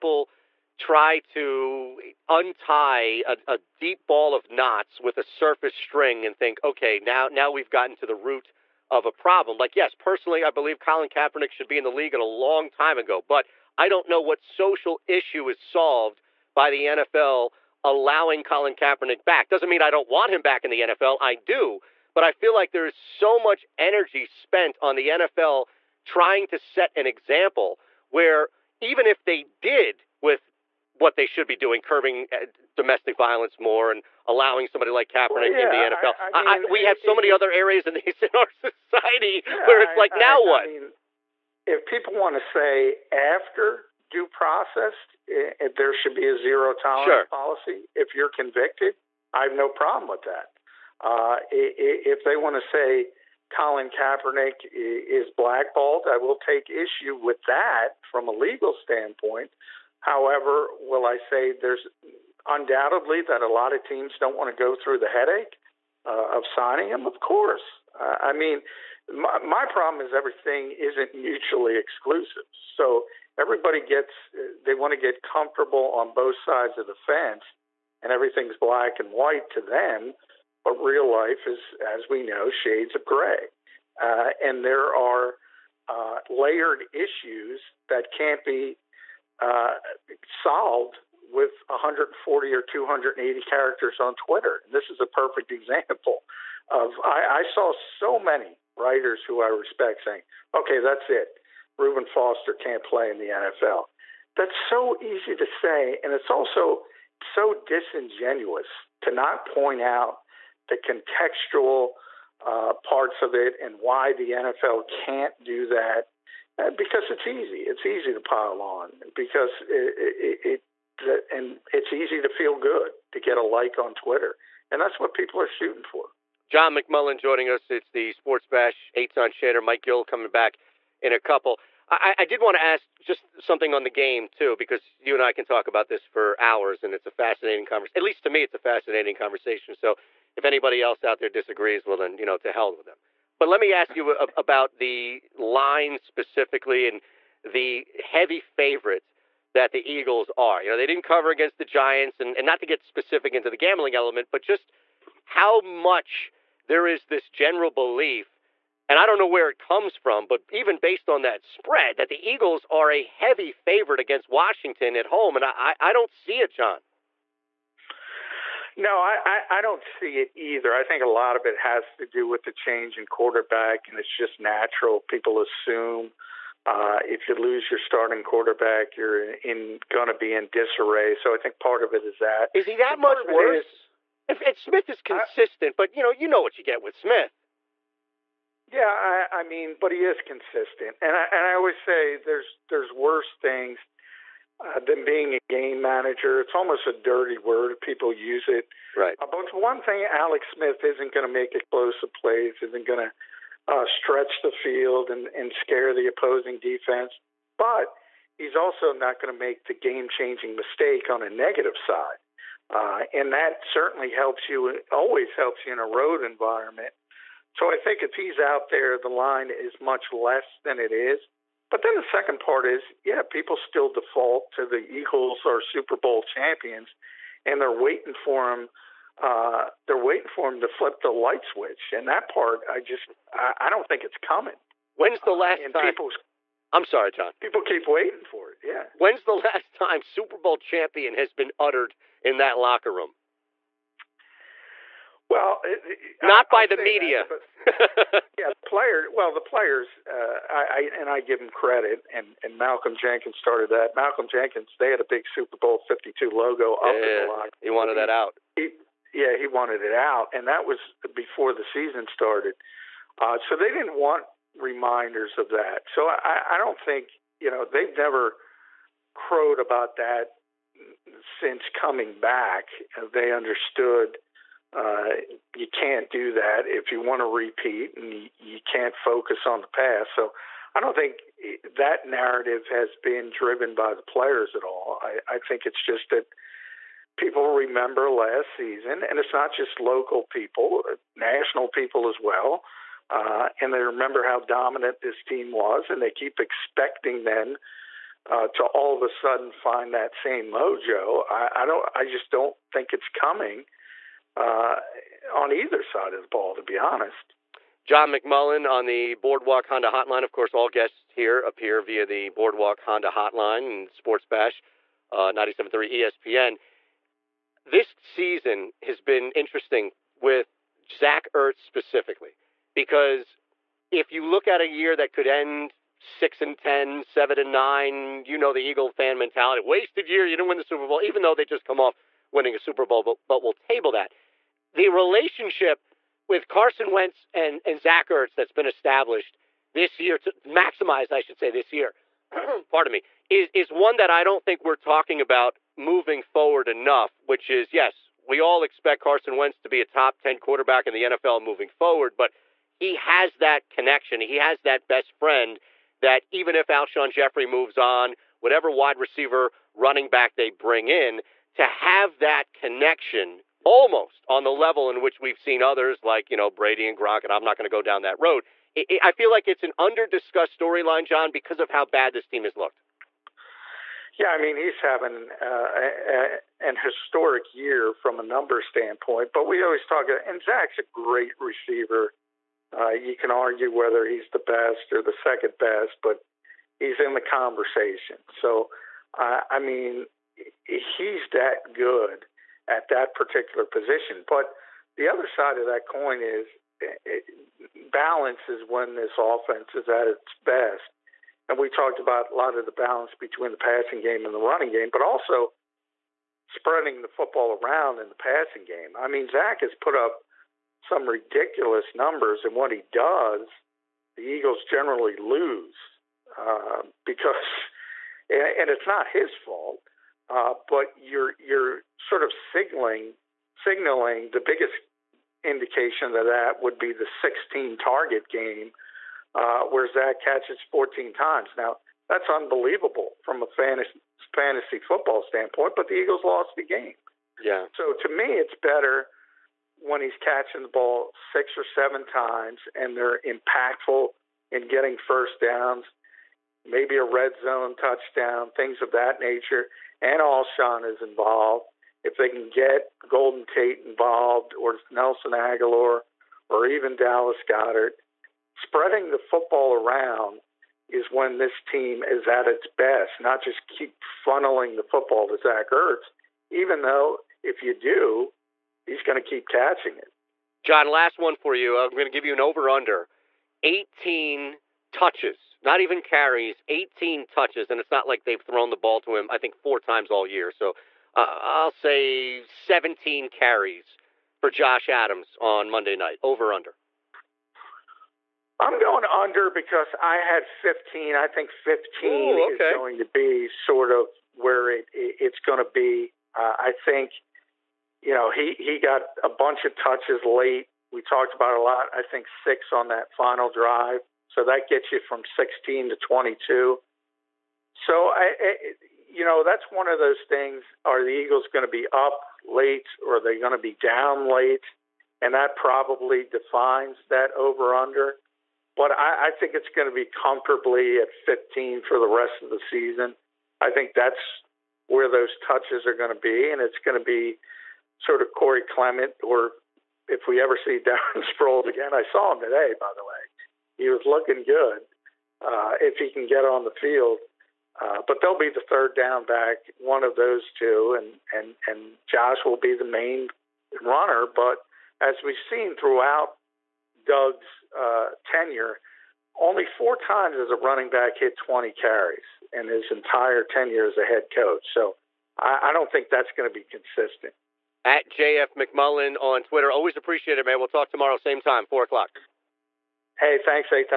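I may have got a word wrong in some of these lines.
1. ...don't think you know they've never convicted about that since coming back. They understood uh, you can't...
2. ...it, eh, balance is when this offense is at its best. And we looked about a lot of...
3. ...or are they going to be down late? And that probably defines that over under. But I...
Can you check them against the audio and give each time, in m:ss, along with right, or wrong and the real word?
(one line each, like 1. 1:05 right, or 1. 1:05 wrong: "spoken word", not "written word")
1. 4:26 wrong: "crowed", not "convicted"
2. 6:36 wrong: "talked", not "looked"
3. 8:33 right.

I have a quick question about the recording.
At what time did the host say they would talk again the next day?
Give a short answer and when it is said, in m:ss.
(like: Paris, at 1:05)
4 o'clock, at 9:21.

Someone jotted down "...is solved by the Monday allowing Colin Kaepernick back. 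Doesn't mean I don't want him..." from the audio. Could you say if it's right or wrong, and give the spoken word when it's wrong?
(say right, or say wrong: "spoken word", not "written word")
wrong: "NFL", not "Monday".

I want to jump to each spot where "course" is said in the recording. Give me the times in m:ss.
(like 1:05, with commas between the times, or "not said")
1:07, 5:10.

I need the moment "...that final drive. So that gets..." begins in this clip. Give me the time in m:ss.
8:22.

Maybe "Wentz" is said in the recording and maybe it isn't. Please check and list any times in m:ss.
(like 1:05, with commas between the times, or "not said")
5:36, 5:49.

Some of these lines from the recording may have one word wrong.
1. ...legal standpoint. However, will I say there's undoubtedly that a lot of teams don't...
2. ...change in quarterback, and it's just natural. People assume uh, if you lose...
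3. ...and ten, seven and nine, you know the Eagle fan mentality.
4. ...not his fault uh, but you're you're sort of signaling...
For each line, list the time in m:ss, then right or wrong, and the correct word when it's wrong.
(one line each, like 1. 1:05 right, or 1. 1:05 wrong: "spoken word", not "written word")
1. 0:58 right
2. 2:52 right
3. 5:26 right
4. 6:58 right.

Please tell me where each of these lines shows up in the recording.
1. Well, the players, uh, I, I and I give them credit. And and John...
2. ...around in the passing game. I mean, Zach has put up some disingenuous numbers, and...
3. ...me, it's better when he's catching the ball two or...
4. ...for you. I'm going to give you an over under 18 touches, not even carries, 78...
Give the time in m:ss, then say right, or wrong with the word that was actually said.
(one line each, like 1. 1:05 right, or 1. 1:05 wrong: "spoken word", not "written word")
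1. 4:09 wrong: "Malcolm", not "John"
2. 6:47 wrong: "ridiculous", not "disingenuous"
3. 7:18 wrong: "six", not "two"
4. 7:51 wrong: "18", not "78".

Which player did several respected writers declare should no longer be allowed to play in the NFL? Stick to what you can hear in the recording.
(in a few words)
Reuben Foster.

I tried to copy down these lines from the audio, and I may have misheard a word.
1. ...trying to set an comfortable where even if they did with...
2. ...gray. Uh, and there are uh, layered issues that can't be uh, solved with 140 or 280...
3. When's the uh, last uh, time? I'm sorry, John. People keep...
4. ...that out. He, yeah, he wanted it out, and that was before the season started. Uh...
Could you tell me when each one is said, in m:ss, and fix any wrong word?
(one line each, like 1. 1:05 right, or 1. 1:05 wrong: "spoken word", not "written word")
1. 0:26 wrong: "example", not "comfortable"
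2. 1:23 right
3. 3:54 right
4. 4:17 right.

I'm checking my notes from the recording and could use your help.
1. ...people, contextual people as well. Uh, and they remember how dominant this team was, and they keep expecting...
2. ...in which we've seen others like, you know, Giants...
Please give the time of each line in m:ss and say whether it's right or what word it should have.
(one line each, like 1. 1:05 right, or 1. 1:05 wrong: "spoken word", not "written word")
1. 4:50 wrong: "national", not "contextual"
2. 6:04 wrong: "Brady", not "Giants".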